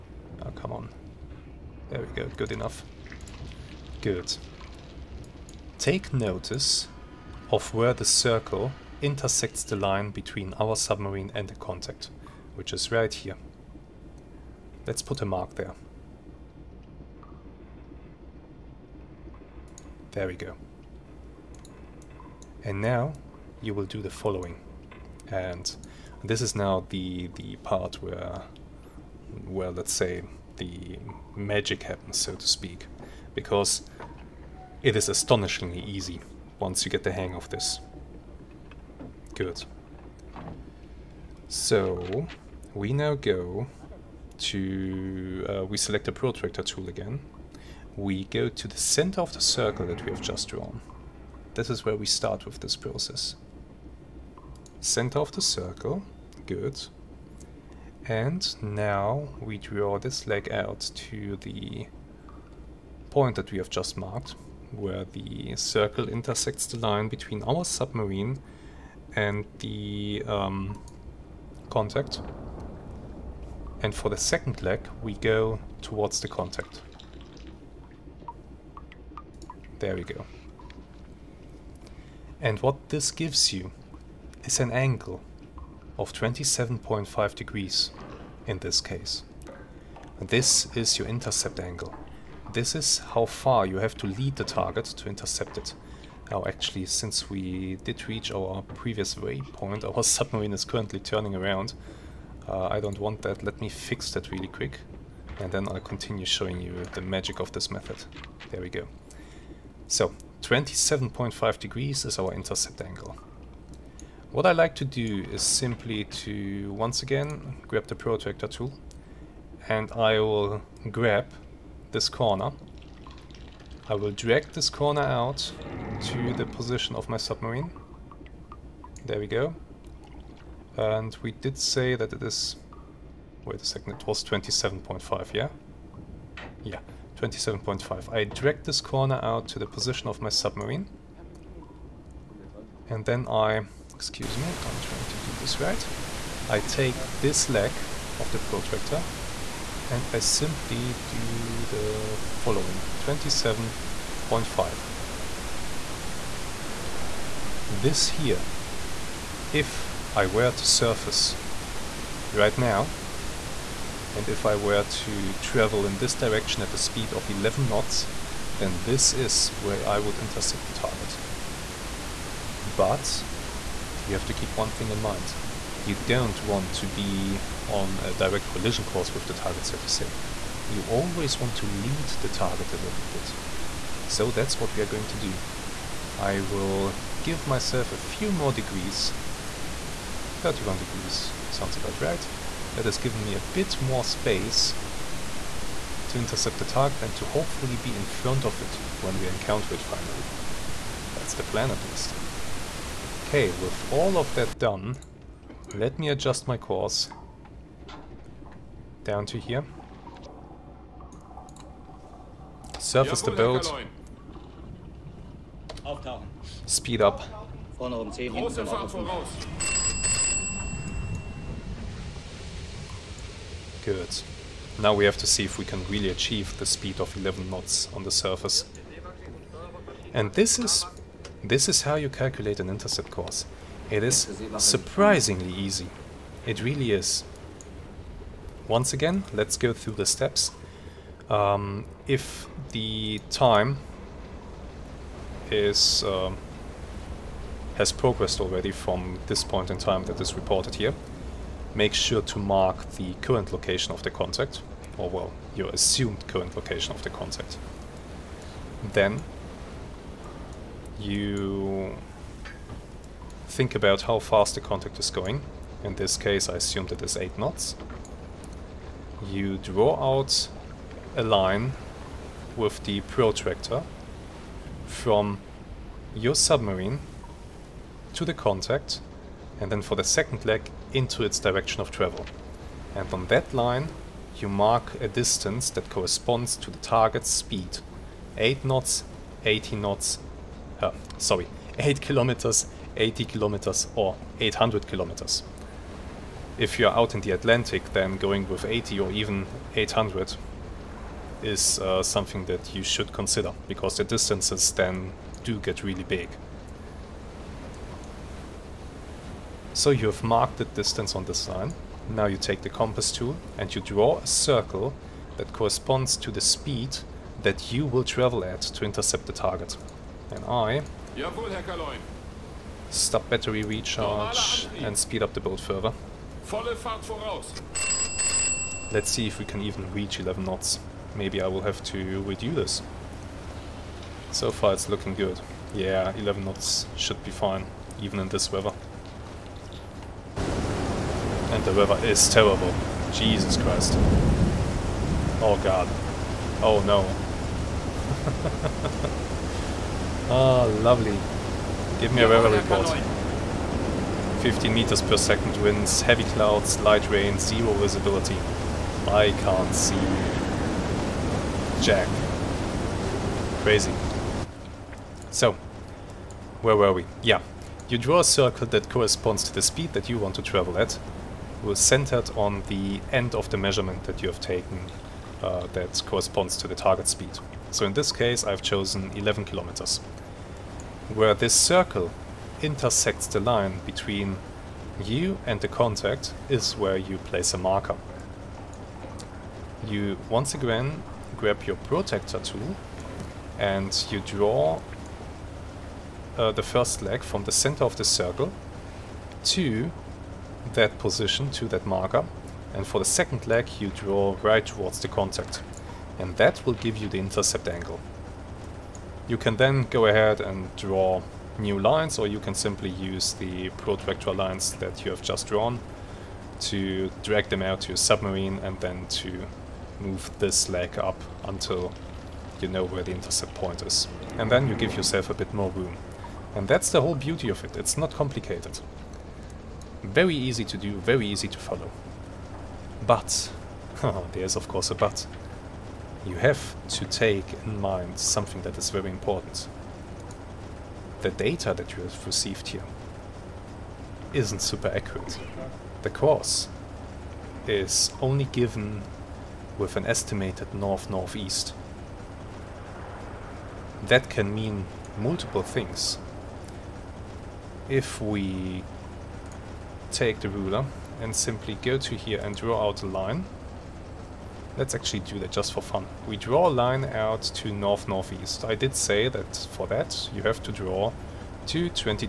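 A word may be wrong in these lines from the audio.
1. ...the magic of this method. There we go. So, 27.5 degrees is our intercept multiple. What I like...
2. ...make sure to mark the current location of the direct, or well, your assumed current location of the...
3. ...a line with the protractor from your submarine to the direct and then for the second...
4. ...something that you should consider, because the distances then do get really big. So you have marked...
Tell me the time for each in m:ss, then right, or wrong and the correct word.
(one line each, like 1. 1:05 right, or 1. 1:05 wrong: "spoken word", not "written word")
1. 1:46 wrong: "angle", not "multiple"
2. 4:11 wrong: "contact", not "direct"
3. 4:31 wrong: "contact", not "direct"
4. 5:02 right.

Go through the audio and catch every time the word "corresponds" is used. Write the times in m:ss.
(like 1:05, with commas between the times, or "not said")
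4:45, 5:15, 6:08, 6:16.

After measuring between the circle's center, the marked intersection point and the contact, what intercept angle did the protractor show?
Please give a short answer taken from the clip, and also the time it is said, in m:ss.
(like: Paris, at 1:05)
27.5 degrees, at 1:26.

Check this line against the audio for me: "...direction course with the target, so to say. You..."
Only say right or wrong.
wrong.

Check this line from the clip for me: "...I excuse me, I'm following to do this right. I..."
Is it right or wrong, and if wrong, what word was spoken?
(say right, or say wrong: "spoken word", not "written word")
wrong: "trying", not "following".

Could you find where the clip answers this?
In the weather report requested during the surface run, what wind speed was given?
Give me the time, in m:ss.
5:54.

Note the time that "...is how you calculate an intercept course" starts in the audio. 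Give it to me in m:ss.
3:51.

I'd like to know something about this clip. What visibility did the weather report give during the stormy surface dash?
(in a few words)
zero.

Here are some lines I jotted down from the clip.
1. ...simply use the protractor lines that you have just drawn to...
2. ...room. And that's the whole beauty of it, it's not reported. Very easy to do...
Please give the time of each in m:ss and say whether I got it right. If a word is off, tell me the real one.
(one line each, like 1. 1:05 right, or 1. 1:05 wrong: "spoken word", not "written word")
1. 6:52 right
2. 7:05 wrong: "complicated", not "reported".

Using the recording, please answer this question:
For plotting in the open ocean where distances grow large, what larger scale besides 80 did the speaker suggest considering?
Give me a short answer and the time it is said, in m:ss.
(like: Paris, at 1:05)
800, at 4:58.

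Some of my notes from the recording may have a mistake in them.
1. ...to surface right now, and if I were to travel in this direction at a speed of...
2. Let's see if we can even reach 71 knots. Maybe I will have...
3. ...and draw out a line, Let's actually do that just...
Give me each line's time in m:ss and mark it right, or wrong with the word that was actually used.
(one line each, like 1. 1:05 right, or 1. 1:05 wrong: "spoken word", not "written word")
1. 2:40 right
2. 5:28 wrong: "11", not "71"
3. 7:42 right.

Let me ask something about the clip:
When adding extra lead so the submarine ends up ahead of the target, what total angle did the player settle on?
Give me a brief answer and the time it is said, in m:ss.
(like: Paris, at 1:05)
31 degrees, at 3:10.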